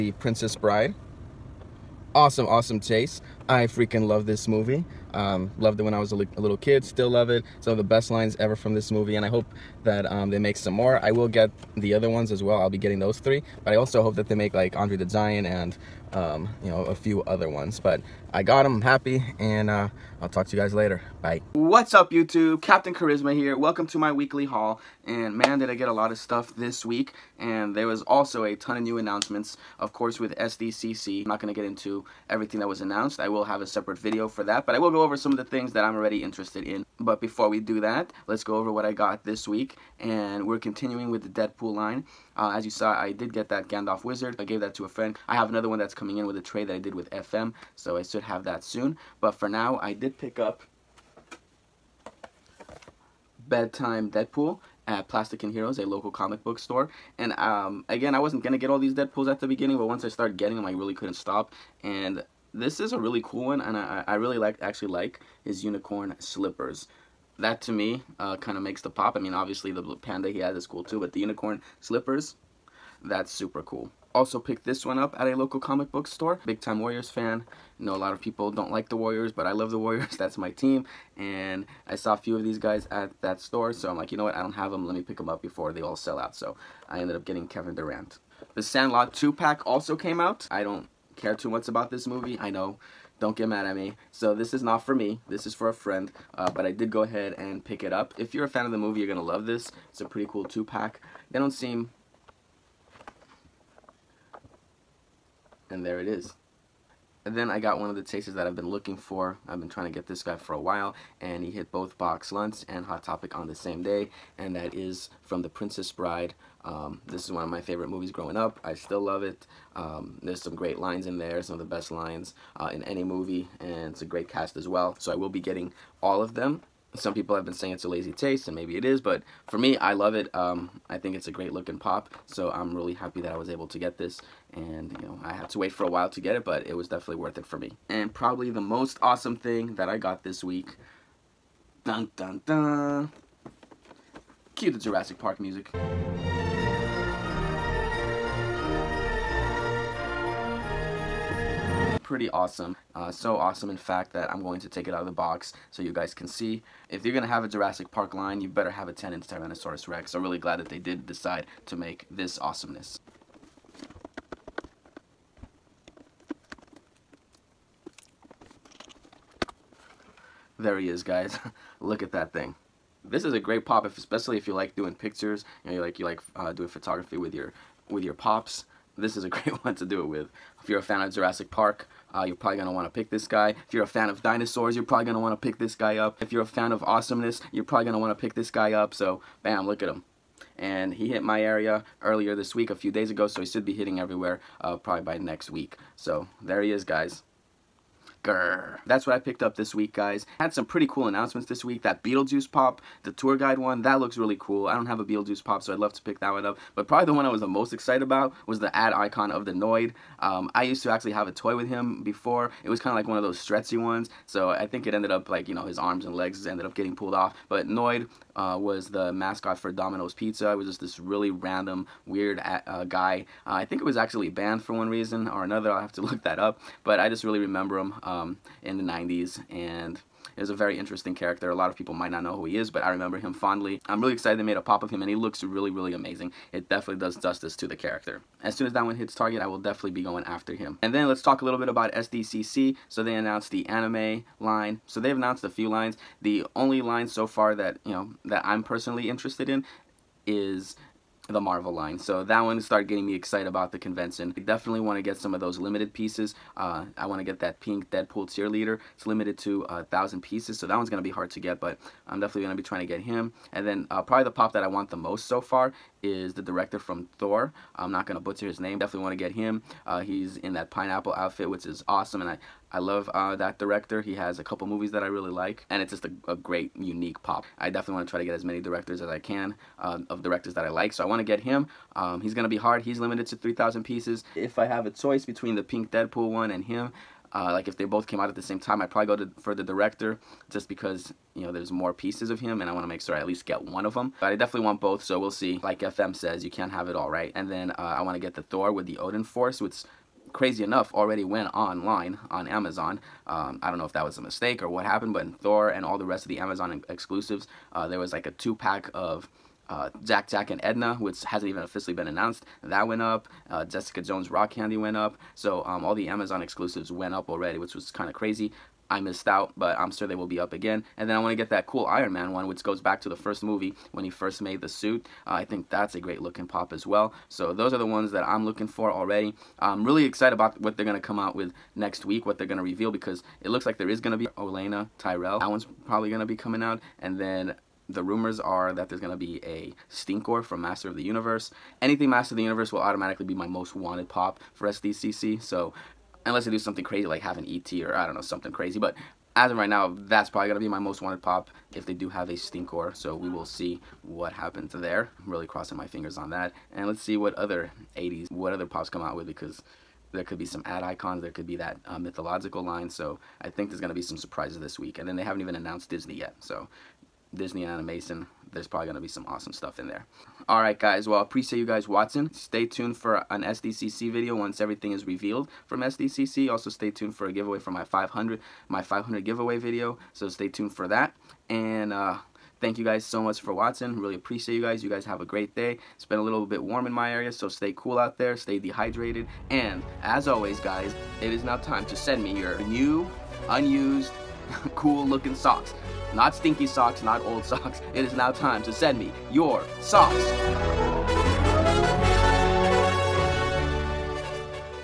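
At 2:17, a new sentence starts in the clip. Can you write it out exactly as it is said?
And probably the most awesome thing that I got this week.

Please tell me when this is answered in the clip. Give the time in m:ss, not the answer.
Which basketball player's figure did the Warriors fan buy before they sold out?
1:27.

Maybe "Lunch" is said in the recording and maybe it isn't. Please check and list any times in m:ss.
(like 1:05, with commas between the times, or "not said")
1:52.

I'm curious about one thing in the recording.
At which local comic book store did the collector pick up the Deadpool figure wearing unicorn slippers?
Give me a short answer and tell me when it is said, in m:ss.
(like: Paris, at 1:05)
Plastic and Heroes, at 0:55.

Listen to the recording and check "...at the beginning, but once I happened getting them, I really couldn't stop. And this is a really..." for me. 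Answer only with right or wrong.
wrong.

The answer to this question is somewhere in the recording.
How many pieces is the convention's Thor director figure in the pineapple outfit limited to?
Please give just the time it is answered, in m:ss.
4:43.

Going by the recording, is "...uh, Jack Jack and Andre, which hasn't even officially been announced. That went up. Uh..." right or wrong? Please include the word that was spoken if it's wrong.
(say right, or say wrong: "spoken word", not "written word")
wrong: "Edna", not "Andre".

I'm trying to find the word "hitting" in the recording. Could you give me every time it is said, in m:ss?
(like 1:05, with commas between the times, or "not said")
3:13.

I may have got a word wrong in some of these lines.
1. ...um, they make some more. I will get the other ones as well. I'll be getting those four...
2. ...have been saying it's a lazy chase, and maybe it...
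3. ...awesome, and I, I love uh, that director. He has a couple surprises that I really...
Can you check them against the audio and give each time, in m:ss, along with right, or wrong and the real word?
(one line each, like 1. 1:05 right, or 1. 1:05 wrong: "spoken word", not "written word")
1. 0:10 wrong: "three", not "four"
2. 2:07 right
3. 4:31 wrong: "movies", not "surprises".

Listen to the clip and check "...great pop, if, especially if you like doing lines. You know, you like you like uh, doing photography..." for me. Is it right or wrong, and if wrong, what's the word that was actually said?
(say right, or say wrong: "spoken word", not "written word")
wrong: "pictures", not "lines".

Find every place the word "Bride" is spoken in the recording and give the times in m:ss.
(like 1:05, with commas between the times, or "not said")
0:00, 1:55.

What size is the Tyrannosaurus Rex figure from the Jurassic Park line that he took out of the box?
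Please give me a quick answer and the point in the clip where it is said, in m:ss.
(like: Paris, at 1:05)
10-inch, at 2:38.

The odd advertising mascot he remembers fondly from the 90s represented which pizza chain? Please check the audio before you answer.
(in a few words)
Domino's Pizza.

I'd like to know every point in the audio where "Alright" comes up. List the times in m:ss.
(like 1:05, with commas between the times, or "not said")
6:10.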